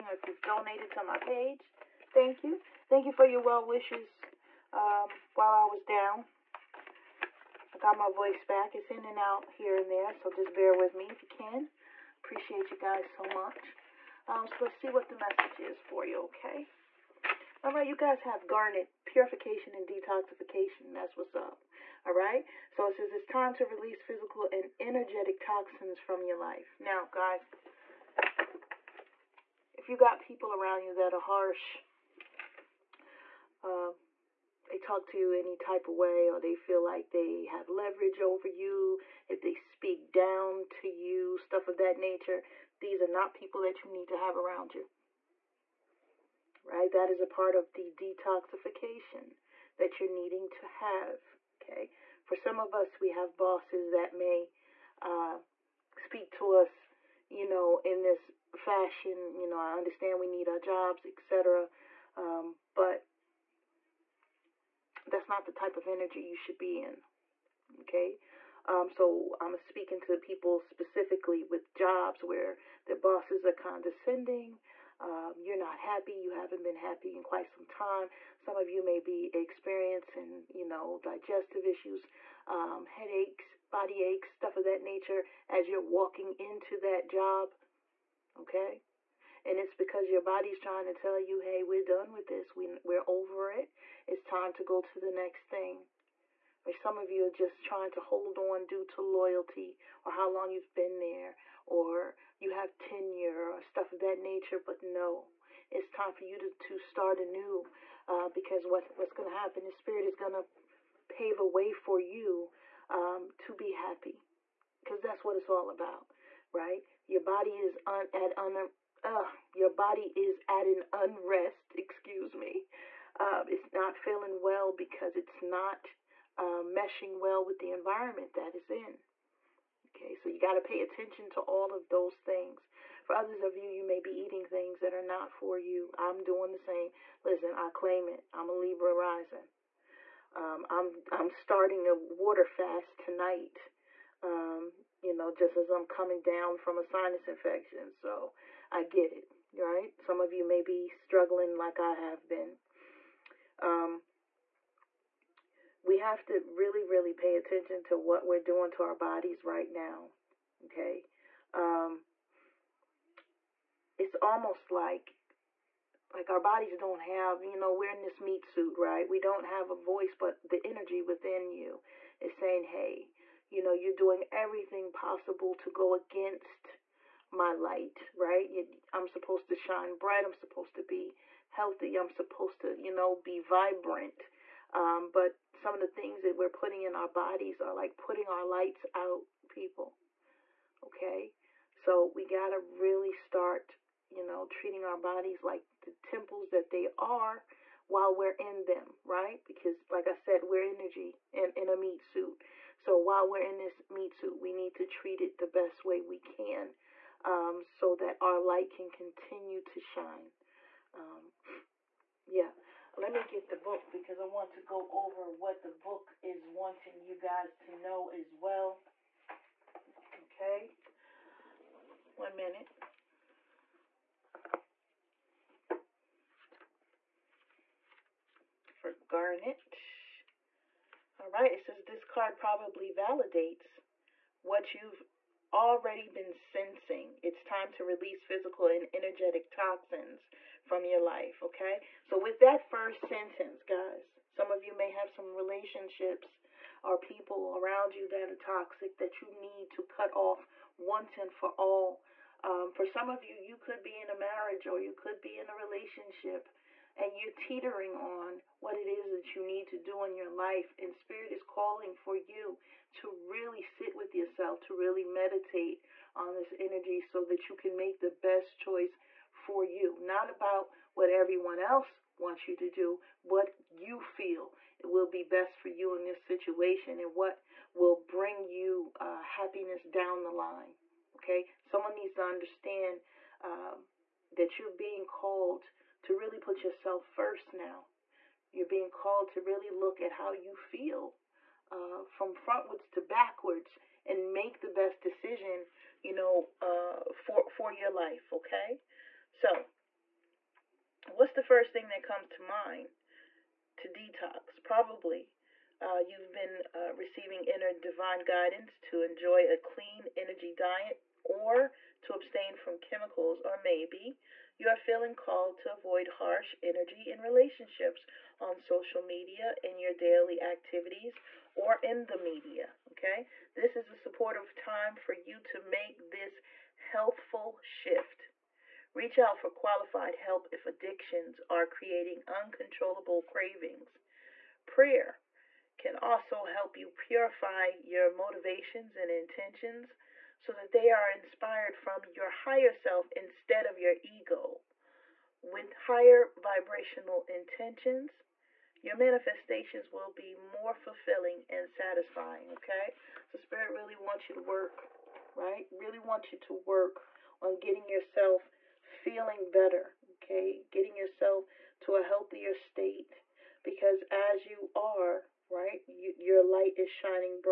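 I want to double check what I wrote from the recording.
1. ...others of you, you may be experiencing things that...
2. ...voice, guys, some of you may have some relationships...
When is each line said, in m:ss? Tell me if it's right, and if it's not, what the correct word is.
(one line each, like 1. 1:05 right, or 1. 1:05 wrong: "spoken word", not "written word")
1. 2:13 wrong: "eating", not "experiencing"
2. 4:03 wrong: "sentence", not "voice".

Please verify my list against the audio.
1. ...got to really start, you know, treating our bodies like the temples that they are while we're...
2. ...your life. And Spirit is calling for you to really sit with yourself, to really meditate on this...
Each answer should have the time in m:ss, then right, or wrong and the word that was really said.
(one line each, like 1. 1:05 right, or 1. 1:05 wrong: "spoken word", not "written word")
1. 3:12 right
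2. 4:20 right.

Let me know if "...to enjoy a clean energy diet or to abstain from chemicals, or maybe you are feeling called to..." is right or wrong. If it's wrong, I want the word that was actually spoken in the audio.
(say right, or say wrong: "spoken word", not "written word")
right.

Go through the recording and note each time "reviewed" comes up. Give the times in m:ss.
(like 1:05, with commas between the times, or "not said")
not said.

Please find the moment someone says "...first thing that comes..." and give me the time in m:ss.
5:01.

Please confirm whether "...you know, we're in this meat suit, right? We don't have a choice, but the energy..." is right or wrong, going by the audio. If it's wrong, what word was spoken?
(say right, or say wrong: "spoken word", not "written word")
wrong: "voice", not "choice".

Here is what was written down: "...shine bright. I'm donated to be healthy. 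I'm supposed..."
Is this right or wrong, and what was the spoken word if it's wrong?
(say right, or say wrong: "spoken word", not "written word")
wrong: "supposed", not "donated".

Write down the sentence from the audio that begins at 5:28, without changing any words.
Reach out for qualified help if addictions are creating uncontrollable cravings.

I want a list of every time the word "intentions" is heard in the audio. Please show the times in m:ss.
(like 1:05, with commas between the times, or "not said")
5:39, 5:47.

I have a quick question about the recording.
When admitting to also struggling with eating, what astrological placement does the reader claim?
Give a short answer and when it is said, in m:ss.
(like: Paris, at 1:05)
Libra rising, at 2:18.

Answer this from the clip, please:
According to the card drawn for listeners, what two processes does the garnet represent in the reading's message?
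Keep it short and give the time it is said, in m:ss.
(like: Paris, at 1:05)
Purification and detoxification, at 0:19.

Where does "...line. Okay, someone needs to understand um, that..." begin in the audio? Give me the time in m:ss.
4:40.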